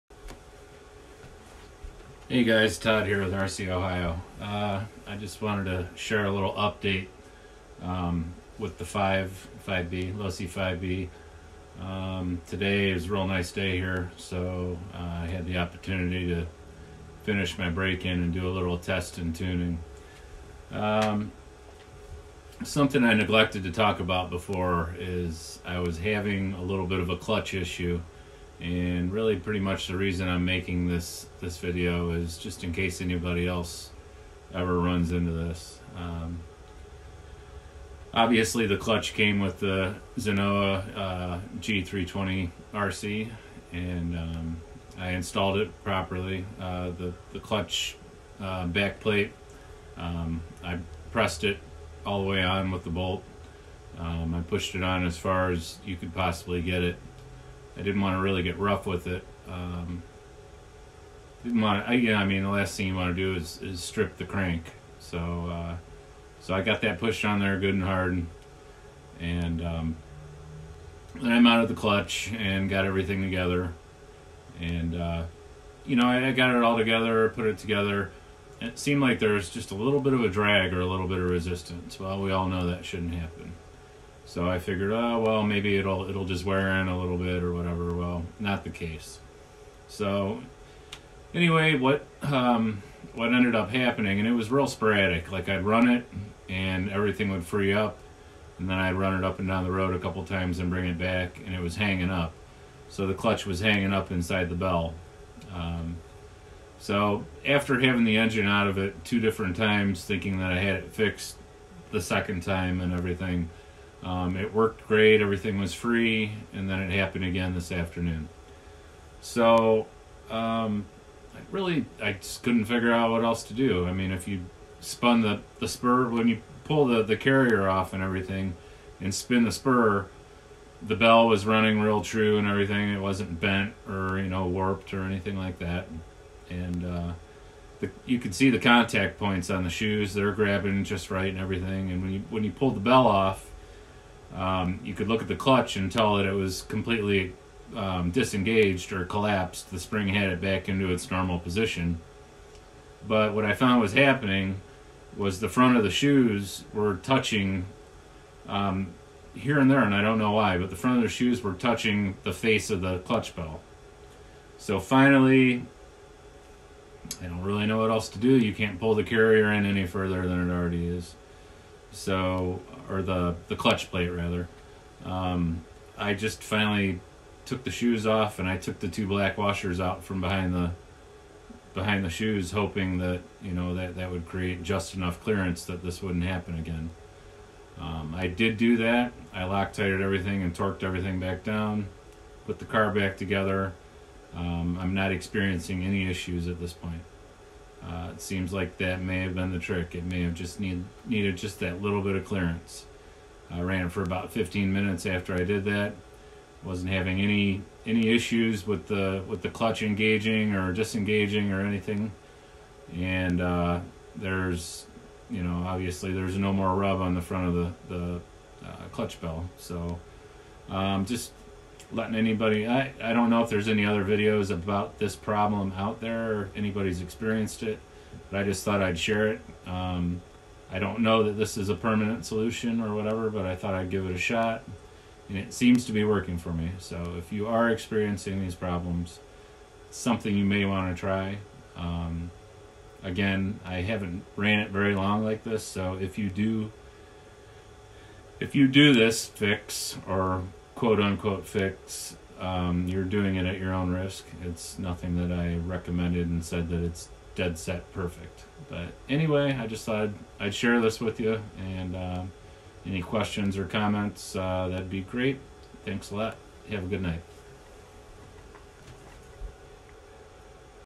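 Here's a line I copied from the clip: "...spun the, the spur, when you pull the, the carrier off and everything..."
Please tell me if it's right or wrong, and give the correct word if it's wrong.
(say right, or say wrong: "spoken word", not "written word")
right.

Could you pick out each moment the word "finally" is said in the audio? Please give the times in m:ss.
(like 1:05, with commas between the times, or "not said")
2:44, 2:56.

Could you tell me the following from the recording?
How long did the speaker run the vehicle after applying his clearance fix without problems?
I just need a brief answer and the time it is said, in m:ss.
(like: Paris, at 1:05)
15 minutes, at 3:24.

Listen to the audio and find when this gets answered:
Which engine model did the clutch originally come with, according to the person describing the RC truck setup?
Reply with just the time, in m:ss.
0:40.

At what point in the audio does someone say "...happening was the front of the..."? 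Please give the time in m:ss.
2:33.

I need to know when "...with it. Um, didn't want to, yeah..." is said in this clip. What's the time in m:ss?
0:58.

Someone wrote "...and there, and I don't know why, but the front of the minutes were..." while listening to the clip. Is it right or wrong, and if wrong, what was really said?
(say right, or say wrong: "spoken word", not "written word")
wrong: "shoes", not "minutes".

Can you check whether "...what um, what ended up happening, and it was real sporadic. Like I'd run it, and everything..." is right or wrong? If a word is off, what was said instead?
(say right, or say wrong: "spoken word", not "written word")
right.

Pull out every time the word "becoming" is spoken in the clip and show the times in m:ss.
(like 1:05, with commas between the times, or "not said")
not said.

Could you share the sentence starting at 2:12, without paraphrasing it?
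It wasn't bent or, you know, warped or anything like that.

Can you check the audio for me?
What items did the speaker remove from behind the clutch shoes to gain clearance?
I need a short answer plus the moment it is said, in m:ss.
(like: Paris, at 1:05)
two black washers, at 2:58.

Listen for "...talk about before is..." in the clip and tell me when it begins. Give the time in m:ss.
0:23.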